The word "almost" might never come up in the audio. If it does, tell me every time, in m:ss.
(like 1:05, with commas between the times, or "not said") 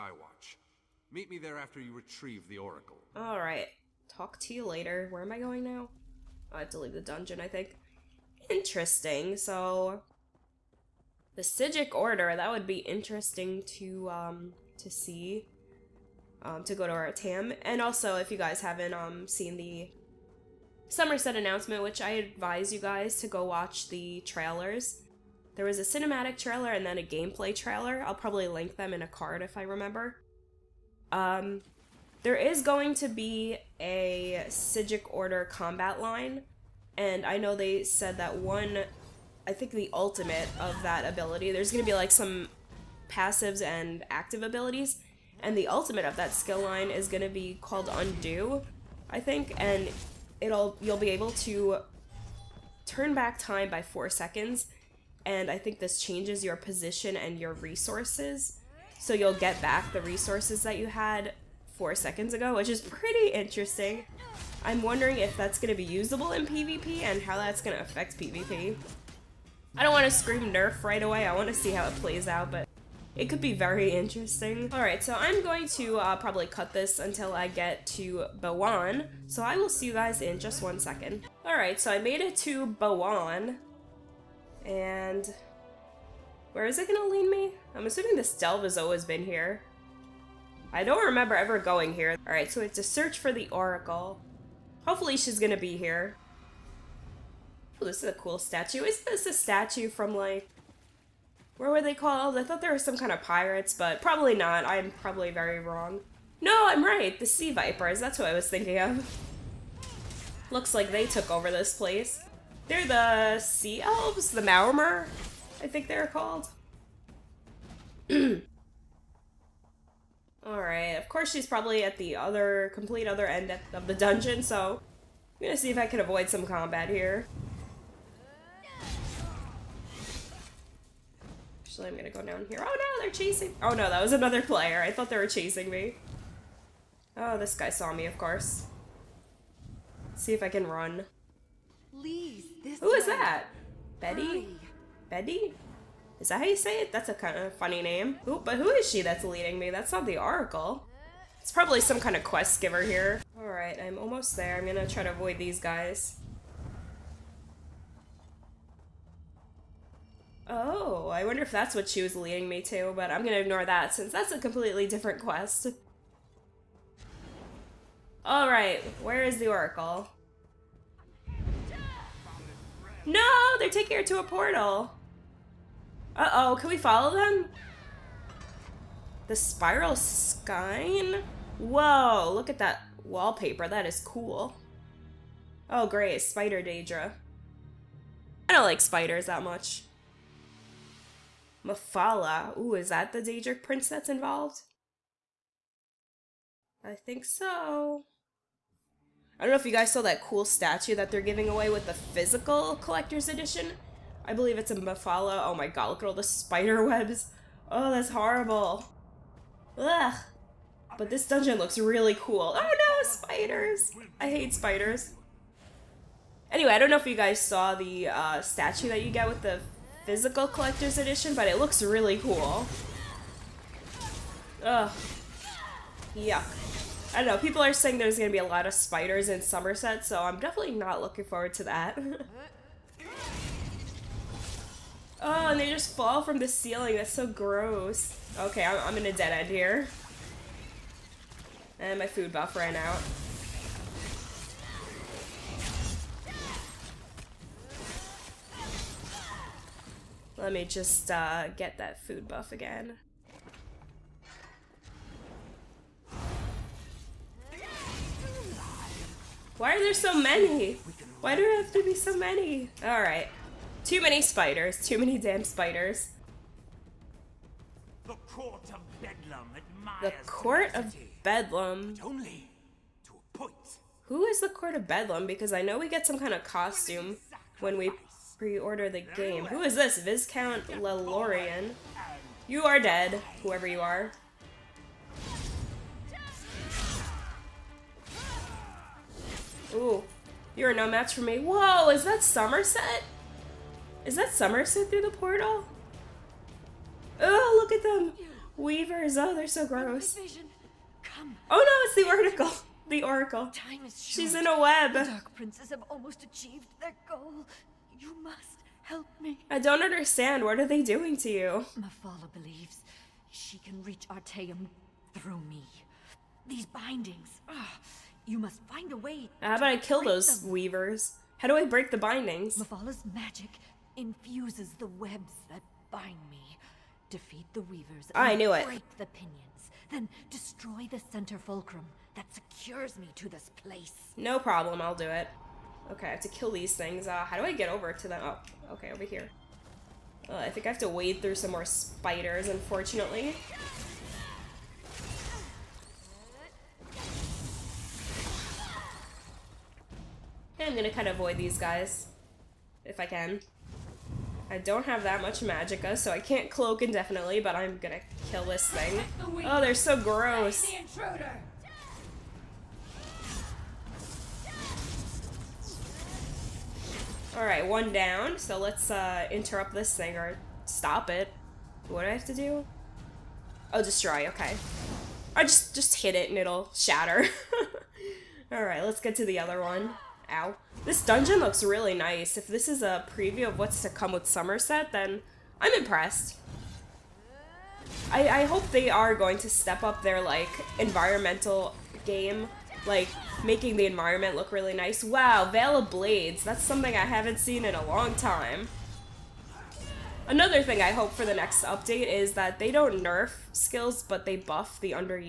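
2:33, 5:05.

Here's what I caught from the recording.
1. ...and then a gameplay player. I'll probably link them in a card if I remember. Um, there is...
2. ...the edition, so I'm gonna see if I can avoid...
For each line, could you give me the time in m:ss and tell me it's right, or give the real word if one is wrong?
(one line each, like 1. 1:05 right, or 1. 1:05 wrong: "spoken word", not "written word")
1. 0:26 wrong: "trailer", not "player"
2. 2:03 wrong: "dungeon", not "edition".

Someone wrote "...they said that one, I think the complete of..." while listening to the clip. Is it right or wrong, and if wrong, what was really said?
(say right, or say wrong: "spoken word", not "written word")
wrong: "ultimate", not "complete".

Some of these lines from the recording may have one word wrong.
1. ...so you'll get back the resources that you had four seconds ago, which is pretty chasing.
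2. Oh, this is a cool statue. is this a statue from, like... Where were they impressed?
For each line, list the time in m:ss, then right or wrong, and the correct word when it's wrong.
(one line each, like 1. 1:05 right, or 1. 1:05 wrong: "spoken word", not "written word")
1. 0:59 wrong: "interesting", not "chasing"
2. 1:37 wrong: "called", not "impressed".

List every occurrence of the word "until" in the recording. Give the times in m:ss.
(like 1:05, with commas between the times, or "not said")
1:16.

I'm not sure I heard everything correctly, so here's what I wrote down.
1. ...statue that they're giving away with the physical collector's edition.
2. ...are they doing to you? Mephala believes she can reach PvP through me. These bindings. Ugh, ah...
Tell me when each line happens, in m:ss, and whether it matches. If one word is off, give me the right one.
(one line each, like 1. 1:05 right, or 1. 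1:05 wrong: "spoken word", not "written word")
1. 3:20 right
2. 5:10 wrong: "Artaeum", not "PvP".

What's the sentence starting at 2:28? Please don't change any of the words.
Ooh, but who is she that's leading me?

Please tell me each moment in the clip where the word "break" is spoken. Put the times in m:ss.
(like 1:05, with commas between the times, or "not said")
5:21, 5:28.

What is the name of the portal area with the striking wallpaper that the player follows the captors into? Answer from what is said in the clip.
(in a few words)
The Spiral Skein.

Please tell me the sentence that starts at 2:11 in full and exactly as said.
Actually, I'm gonna go down here.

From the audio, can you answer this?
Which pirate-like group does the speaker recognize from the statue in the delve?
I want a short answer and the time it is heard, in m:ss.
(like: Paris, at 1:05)
The Sea Vipers, at 1:47.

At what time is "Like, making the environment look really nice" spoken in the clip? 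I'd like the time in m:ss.
6:32.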